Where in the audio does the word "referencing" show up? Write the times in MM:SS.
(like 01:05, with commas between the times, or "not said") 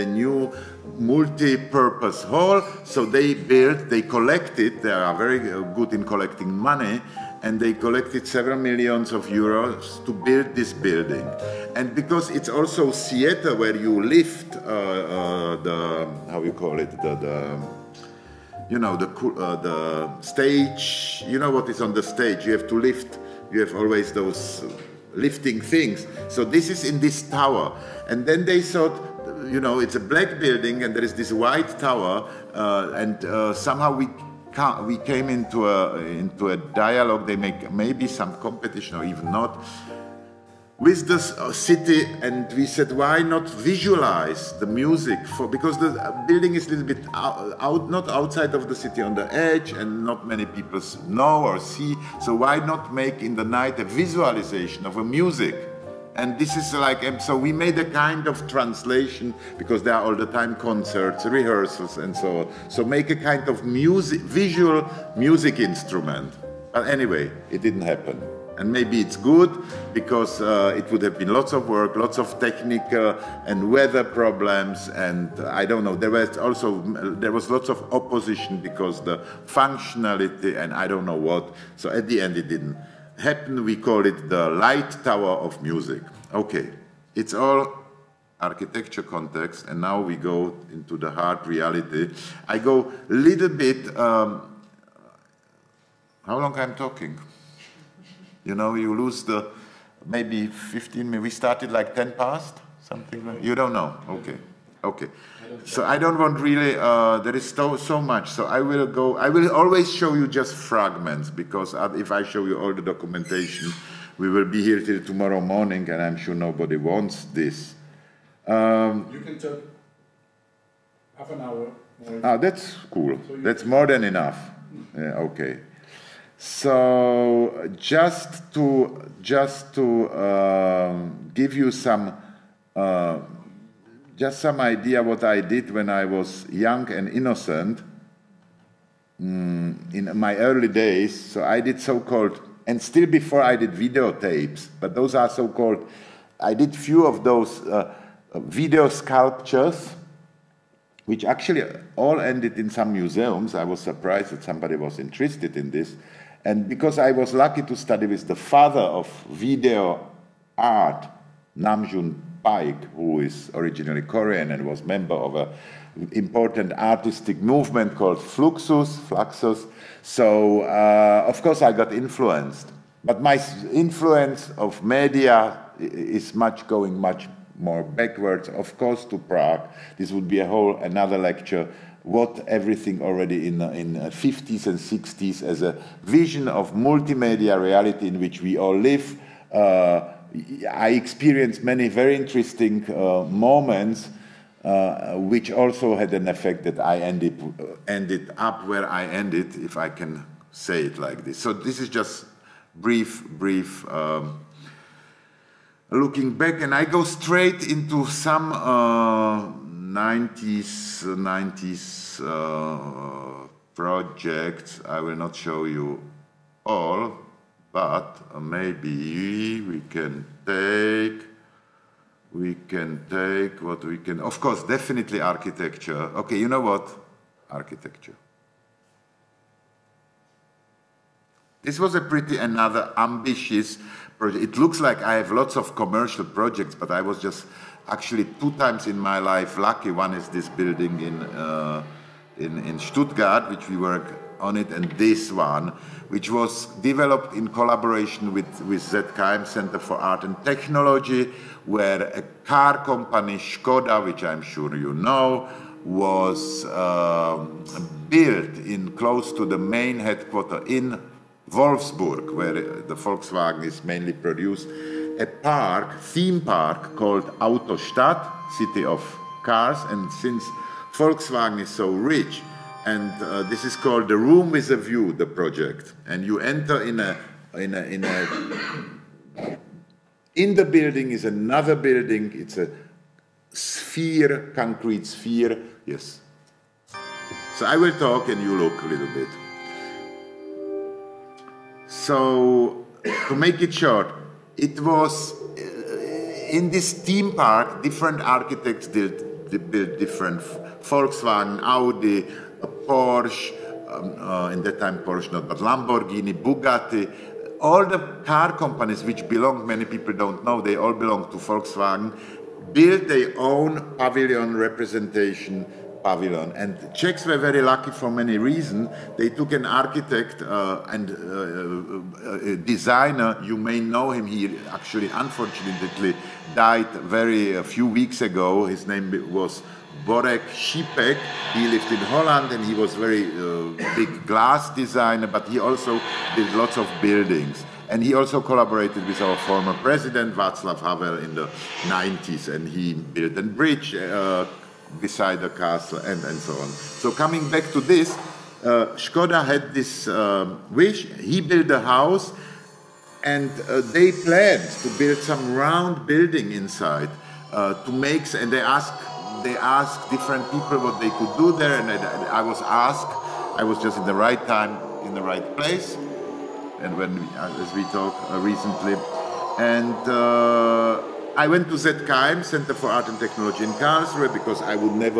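not said.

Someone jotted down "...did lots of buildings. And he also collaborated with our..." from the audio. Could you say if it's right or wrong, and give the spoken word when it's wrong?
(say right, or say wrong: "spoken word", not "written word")
right.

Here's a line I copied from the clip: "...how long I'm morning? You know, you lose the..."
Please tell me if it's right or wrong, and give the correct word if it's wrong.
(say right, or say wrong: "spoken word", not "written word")
wrong: "talking", not "morning".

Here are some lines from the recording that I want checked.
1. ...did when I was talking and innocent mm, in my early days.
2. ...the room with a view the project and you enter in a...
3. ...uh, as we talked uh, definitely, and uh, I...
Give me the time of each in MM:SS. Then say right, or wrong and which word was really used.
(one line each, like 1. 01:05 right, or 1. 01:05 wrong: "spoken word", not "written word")
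1. 02:15 wrong: "young", not "talking"
2. 04:34 right
3. 06:07 wrong: "recently", not "definitely".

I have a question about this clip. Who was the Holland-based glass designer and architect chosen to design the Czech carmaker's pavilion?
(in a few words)
Borek Šipek.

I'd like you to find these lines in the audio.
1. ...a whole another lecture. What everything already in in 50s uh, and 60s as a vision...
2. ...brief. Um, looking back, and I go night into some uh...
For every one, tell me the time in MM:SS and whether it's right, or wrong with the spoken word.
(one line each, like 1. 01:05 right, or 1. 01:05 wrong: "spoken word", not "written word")
1. 03:00 right
2. 03:23 wrong: "straight", not "night".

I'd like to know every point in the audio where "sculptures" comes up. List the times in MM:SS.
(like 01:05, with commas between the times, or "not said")
02:28.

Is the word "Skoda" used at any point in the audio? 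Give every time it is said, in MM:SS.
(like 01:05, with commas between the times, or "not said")
04:13, 05:48.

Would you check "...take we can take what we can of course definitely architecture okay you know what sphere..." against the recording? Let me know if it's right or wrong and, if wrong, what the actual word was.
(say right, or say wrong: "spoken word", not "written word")
wrong: "architecture", not "sphere".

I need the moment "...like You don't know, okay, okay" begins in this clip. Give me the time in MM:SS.
01:43.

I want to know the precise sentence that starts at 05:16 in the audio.
And Czechs were very lucky for many reasons.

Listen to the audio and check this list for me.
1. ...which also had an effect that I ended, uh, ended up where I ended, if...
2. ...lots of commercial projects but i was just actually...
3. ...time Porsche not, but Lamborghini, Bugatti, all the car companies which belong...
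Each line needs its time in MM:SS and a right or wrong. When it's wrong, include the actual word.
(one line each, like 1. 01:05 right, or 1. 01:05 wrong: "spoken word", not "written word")
1. 03:15 right
2. 03:55 right
3. 05:04 right.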